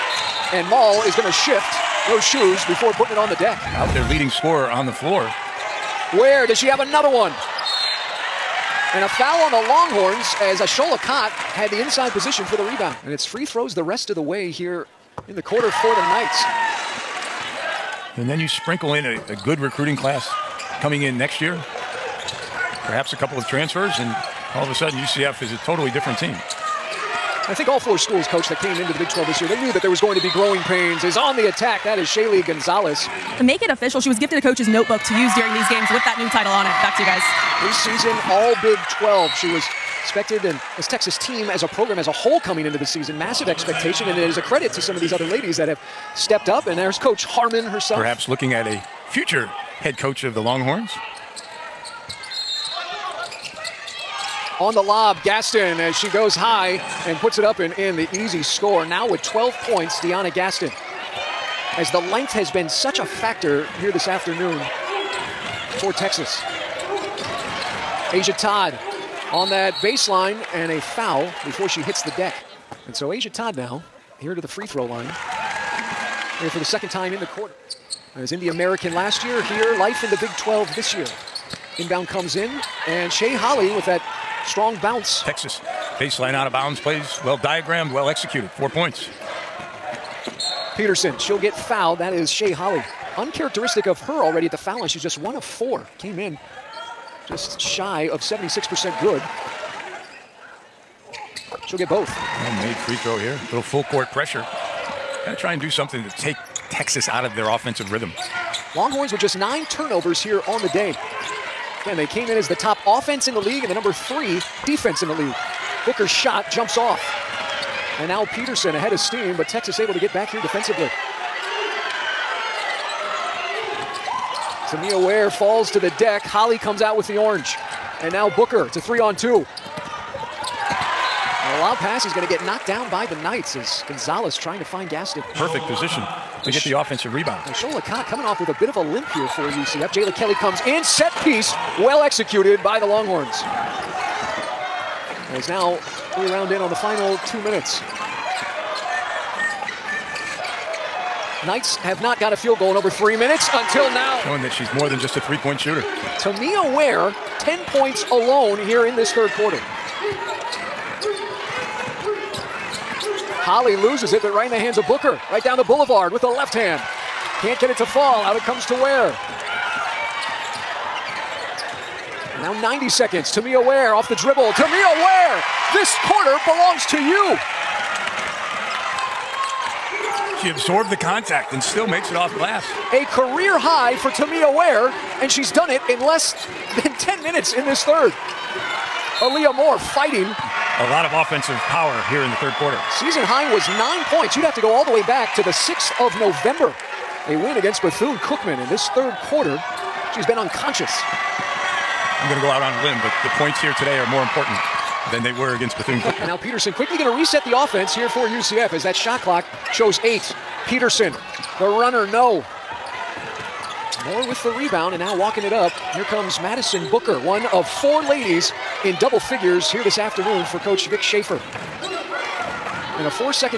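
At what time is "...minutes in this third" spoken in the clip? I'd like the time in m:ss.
3:07.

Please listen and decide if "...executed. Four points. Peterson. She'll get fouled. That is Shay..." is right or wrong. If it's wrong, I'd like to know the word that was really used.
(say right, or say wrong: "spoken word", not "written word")
right.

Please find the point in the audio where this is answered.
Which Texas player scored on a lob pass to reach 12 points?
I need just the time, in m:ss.
0:59.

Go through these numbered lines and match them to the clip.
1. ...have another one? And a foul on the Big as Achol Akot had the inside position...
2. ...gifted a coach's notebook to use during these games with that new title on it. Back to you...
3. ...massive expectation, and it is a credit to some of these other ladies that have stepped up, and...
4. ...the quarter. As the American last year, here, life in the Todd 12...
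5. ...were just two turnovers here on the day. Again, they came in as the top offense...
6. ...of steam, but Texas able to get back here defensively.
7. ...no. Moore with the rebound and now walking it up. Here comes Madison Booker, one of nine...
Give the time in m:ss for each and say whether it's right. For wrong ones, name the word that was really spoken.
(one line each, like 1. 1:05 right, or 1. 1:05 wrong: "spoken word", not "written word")
1. 0:06 wrong: "Longhorns", not "Big"
2. 0:34 right
3. 0:43 right
4. 1:17 wrong: "Big", not "Todd"
5. 1:49 wrong: "nine", not "two"
6. 1:58 right
7. 3:32 wrong: "four", not "nine".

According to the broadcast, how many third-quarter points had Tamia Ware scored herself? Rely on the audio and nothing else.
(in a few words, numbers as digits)
10.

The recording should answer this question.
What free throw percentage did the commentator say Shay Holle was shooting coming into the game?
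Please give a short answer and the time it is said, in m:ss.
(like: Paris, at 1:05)
76%, at 1:38.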